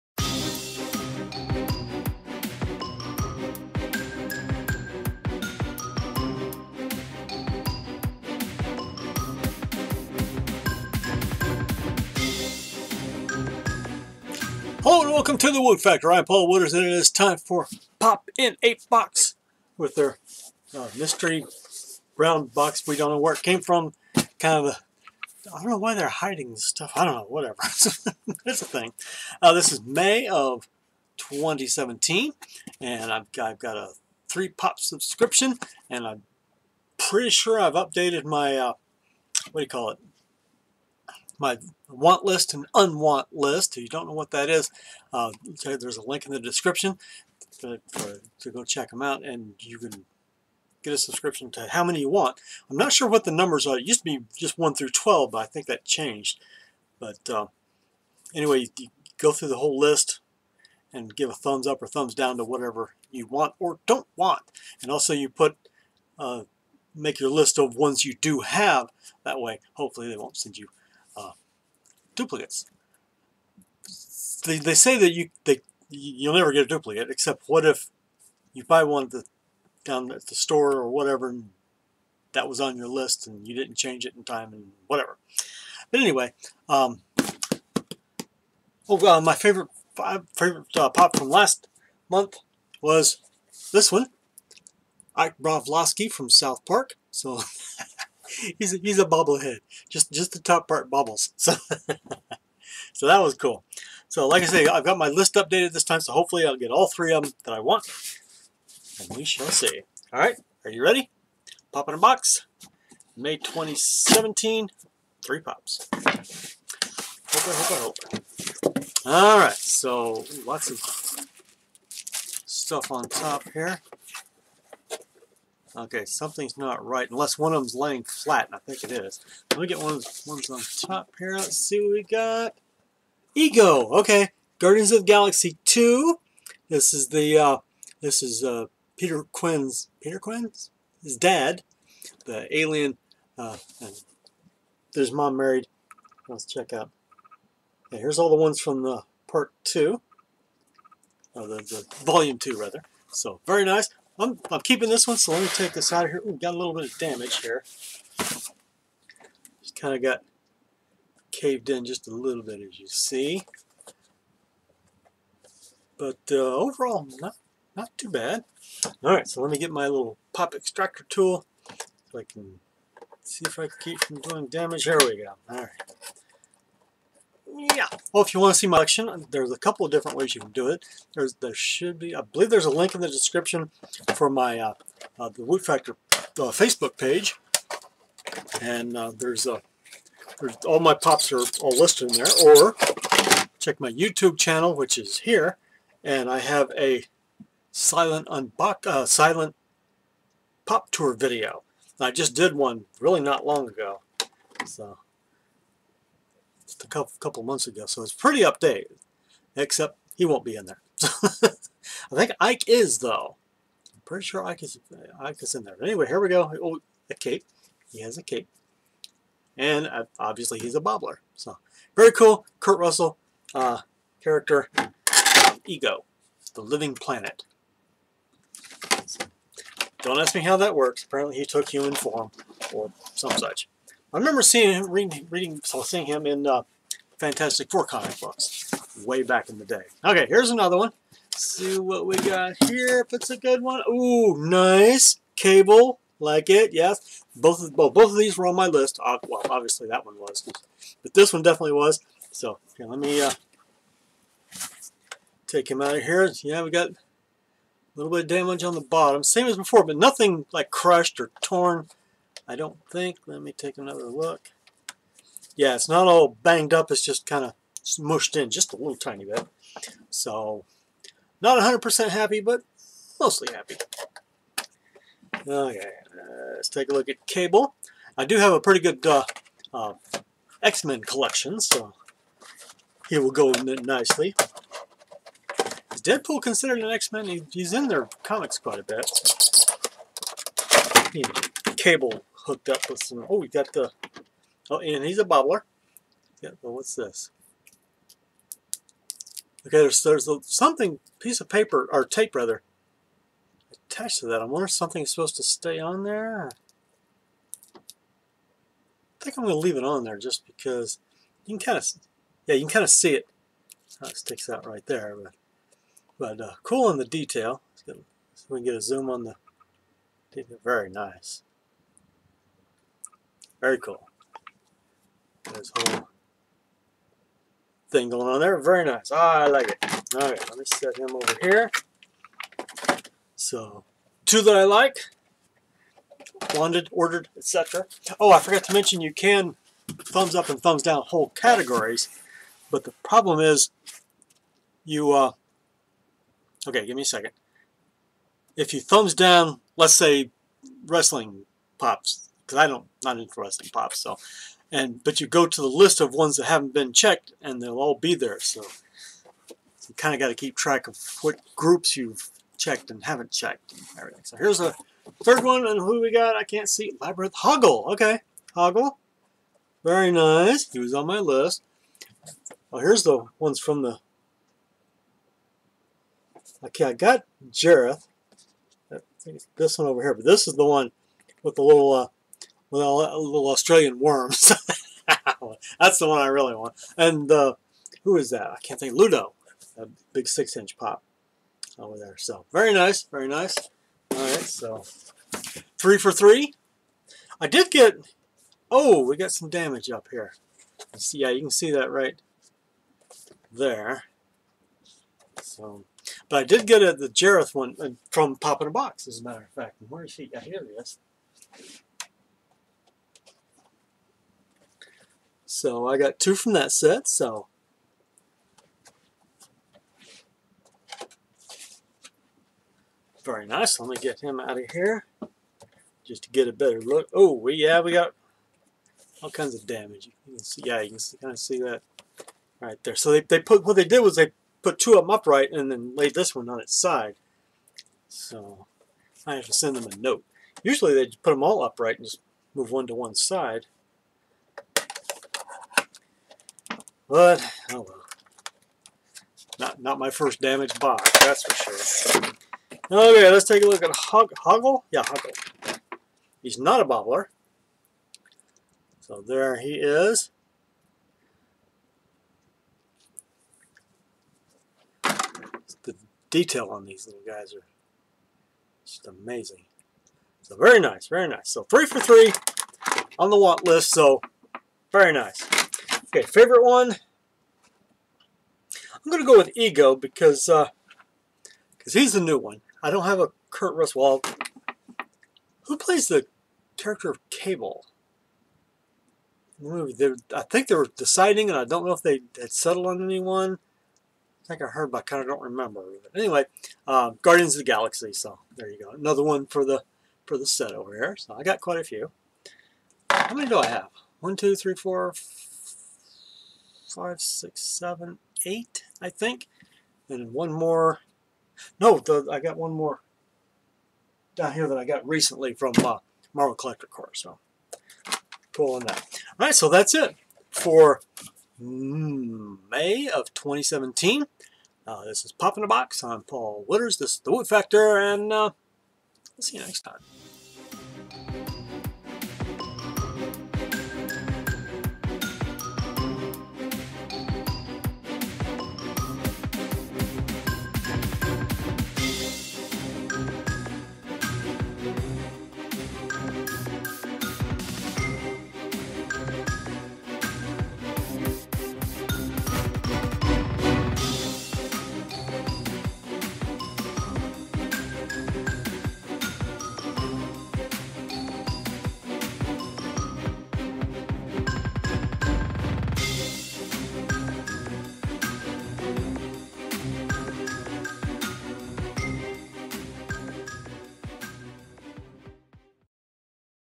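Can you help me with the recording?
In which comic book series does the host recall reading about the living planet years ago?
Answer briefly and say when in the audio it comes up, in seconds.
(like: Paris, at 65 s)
Fantastic Four, at 237 s.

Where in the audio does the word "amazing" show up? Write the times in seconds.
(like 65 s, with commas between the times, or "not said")
469 s.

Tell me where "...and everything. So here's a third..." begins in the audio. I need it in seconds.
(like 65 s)
363 s.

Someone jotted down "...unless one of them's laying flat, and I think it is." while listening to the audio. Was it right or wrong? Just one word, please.
right.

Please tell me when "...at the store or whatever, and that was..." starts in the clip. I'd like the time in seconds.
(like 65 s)
80 s.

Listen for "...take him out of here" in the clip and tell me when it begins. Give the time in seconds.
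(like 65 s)
255 s.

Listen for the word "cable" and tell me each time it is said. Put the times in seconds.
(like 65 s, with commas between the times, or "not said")
245 s, 277 s, 291 s, 487 s.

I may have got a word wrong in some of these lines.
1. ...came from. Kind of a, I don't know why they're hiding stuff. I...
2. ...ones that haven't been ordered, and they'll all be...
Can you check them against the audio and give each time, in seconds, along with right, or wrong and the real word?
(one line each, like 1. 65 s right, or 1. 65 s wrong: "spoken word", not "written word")
1. 23 s right
2. 356 s wrong: "checked", not "ordered".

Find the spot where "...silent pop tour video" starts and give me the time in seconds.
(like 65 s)
199 s.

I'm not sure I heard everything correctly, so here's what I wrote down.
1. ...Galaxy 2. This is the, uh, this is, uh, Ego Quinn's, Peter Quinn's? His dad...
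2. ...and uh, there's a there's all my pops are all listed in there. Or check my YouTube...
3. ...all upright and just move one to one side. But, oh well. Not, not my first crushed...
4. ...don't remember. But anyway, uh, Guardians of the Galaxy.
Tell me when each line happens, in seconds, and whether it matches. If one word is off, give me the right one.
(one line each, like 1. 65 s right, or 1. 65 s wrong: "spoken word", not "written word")
1. 135 s wrong: "Peter", not "Ego"
2. 188 s right
3. 441 s wrong: "damaged", not "crushed"
4. 495 s right.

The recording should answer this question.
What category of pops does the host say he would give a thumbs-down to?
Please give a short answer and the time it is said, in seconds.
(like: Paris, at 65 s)
wrestling, at 350 s.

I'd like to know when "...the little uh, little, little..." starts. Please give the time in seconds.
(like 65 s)
381 s.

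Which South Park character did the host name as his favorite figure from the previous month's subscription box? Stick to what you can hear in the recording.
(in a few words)
Ike Broflovski.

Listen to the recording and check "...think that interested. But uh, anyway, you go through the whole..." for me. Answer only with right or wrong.
wrong.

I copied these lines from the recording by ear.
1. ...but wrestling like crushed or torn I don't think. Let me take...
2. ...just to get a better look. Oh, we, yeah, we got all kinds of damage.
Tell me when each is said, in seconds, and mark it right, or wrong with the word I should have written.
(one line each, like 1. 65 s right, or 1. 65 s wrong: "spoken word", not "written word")
1. 259 s wrong: "nothing", not "wrestling"
2. 426 s right.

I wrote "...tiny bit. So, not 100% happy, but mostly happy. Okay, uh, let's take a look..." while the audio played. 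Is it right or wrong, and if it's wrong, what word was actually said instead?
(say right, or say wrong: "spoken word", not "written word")
right.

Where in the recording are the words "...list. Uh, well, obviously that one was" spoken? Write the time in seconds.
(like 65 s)
248 s.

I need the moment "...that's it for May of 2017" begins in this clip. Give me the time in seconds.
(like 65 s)
519 s.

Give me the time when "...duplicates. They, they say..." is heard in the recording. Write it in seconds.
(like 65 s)
72 s.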